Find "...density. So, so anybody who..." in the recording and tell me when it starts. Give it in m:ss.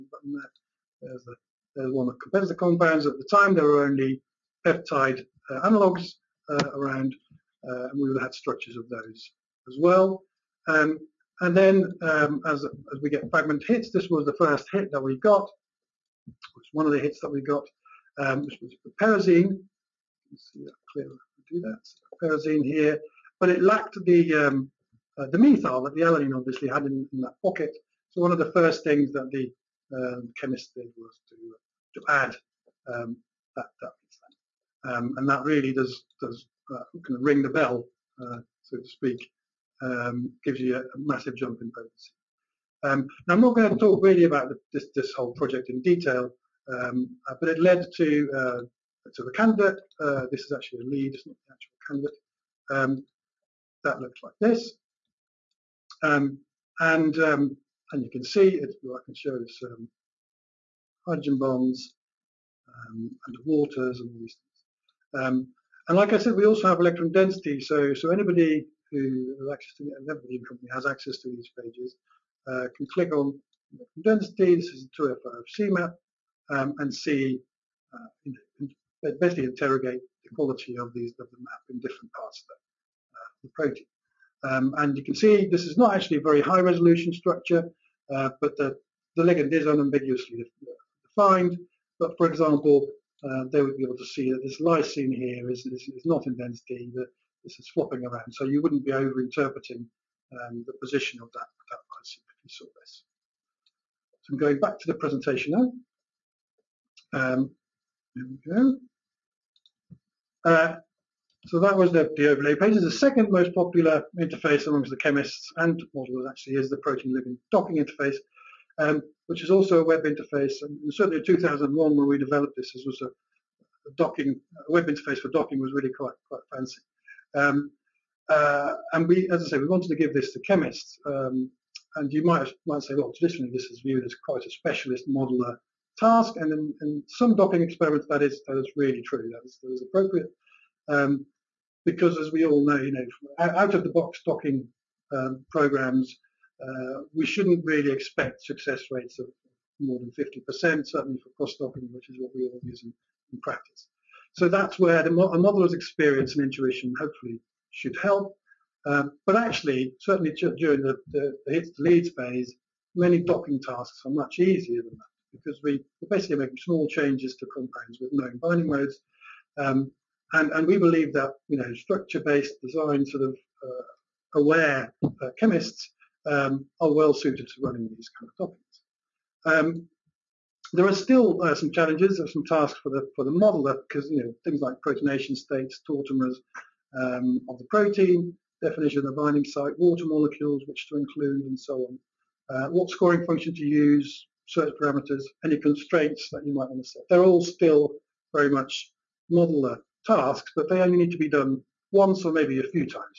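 1:07.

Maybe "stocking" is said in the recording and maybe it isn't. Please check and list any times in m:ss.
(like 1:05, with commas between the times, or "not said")
2:24, 2:31.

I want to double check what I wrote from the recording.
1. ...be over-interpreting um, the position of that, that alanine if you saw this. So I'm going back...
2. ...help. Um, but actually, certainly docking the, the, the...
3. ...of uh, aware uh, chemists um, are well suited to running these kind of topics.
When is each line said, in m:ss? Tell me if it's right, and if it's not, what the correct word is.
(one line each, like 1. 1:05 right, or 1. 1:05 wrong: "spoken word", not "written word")
1. 1:38 wrong: "lysine", not "alanine"
2. 2:38 wrong: "during", not "docking"
3. 2:53 right.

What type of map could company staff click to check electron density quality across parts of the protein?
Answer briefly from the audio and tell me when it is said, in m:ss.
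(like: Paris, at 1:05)
2 c map, at 1:15.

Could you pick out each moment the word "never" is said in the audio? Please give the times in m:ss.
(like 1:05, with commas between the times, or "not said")
not said.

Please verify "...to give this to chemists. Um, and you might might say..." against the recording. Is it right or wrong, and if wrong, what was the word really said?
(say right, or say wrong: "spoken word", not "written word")
right.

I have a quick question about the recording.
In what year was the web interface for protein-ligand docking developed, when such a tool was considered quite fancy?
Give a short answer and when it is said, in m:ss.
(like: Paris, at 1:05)
2001, at 2:01.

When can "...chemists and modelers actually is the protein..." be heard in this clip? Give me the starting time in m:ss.
1:54.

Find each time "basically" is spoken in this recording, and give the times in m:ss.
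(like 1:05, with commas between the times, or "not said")
1:19, 2:46.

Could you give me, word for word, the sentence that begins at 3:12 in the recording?
Uh, what scoring function to use, search parameters, any constraints that you might want to set.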